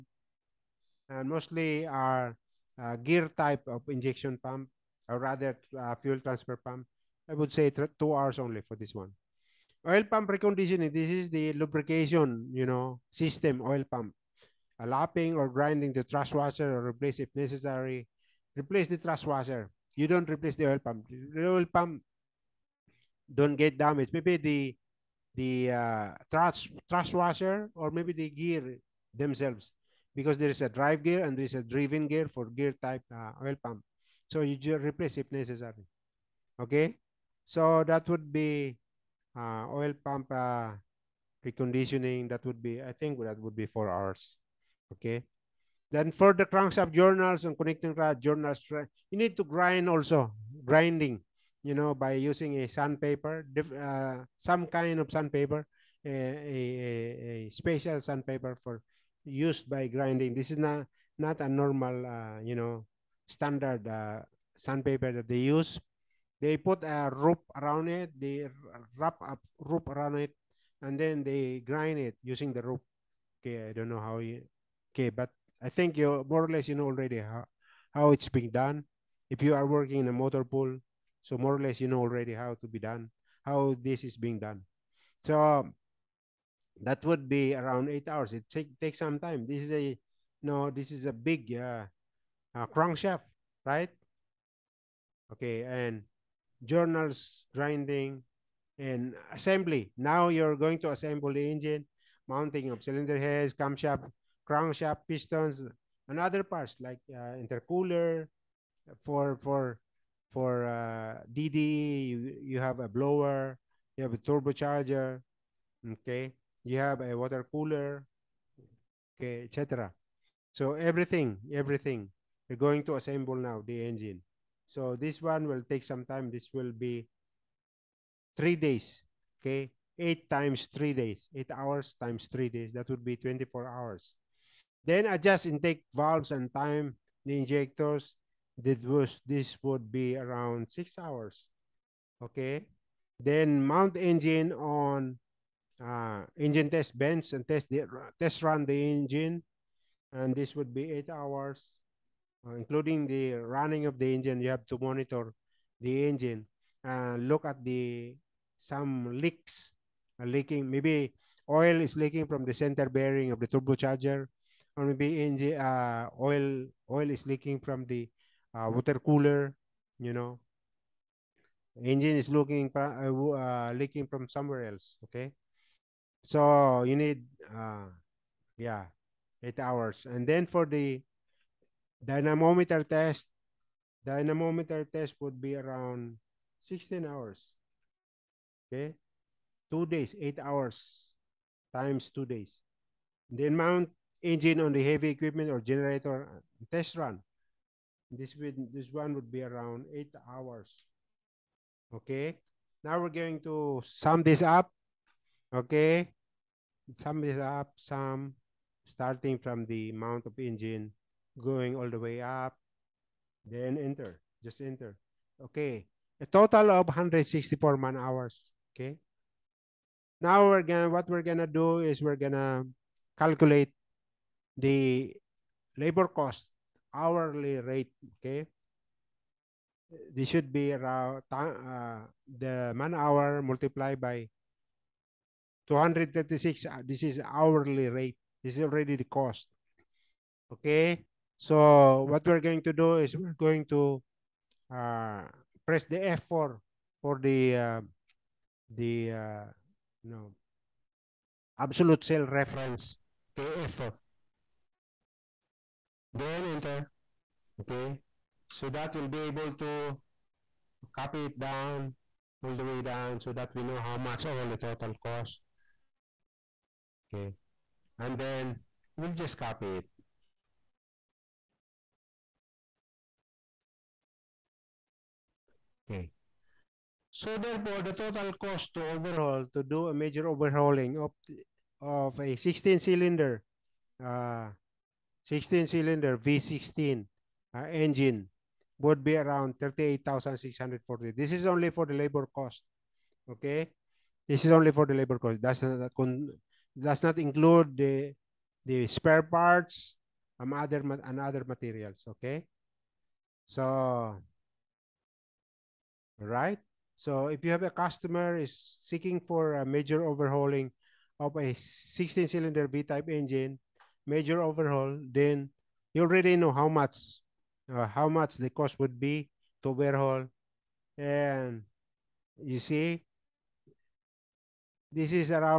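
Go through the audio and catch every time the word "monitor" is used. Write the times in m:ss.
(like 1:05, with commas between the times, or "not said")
2:34.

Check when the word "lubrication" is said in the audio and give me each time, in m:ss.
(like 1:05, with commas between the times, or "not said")
0:11.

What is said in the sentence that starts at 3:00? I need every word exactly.
And then for the dynamometer test, dynamometer test would be around 16 hours.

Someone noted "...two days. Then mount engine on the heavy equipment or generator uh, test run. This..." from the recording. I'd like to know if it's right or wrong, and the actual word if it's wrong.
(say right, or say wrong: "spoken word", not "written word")
right.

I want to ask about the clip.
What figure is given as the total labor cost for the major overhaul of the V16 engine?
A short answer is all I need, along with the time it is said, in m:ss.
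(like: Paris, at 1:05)
38,640, at 4:49.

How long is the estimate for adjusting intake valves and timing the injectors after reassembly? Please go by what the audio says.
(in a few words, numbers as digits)
6 hours.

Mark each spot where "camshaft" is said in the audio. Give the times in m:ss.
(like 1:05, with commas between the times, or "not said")
1:43.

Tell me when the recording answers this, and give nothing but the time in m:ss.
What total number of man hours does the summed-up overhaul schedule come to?
3:36.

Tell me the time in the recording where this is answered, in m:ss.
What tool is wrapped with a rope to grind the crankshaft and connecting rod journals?
0:57.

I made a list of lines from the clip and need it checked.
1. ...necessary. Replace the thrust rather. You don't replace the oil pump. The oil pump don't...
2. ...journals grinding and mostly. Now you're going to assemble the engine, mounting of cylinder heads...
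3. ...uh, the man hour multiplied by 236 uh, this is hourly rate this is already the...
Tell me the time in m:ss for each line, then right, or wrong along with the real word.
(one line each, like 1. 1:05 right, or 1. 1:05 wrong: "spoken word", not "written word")
1. 0:17 wrong: "washer", not "rather"
2. 1:36 wrong: "assembly", not "mostly"
3. 3:51 right.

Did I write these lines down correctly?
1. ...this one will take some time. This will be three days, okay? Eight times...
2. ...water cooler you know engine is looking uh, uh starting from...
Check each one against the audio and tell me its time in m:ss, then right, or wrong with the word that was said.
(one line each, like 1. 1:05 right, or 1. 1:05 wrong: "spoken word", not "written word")
1. 2:04 right
2. 2:48 wrong: "leaking", not "starting".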